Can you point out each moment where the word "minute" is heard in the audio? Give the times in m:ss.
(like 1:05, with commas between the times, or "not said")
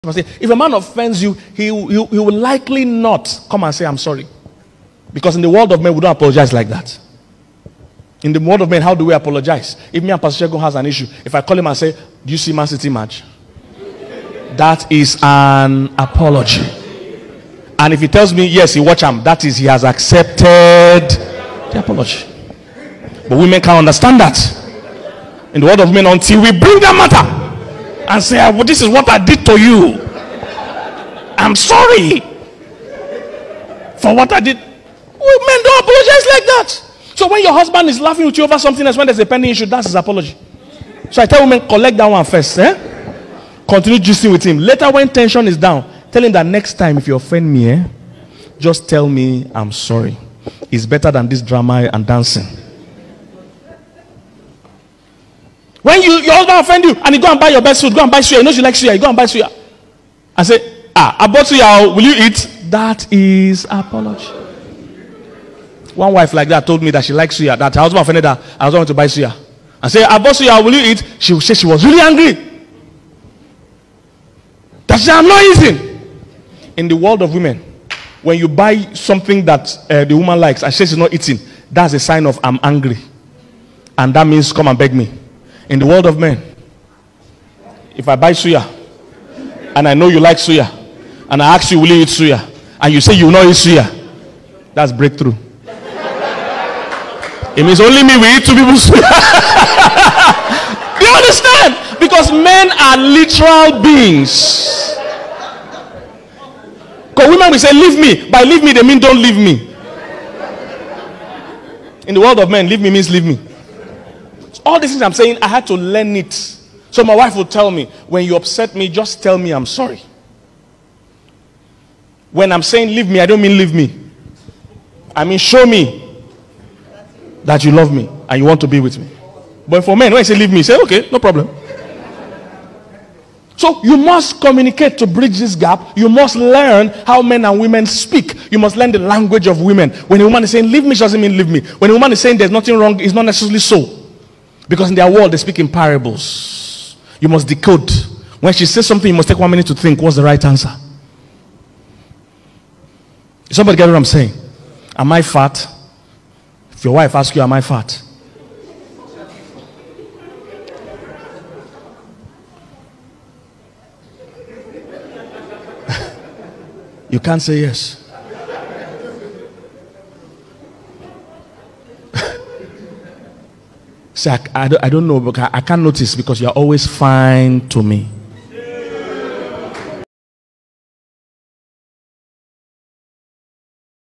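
2:29.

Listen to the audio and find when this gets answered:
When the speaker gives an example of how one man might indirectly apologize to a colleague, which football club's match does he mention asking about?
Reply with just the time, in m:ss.
0:12.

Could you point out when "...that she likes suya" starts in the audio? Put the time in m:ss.
1:06.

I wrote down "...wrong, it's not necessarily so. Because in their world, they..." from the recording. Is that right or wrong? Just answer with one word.
right.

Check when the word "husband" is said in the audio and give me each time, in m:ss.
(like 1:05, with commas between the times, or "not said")
0:37, 0:56, 1:07.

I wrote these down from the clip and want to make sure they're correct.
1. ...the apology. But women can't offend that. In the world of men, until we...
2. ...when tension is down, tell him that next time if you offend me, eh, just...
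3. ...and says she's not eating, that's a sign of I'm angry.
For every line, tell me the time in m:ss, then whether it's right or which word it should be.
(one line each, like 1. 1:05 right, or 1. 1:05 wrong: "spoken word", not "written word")
1. 0:21 wrong: "understand", not "offend"
2. 0:44 right
3. 1:20 right.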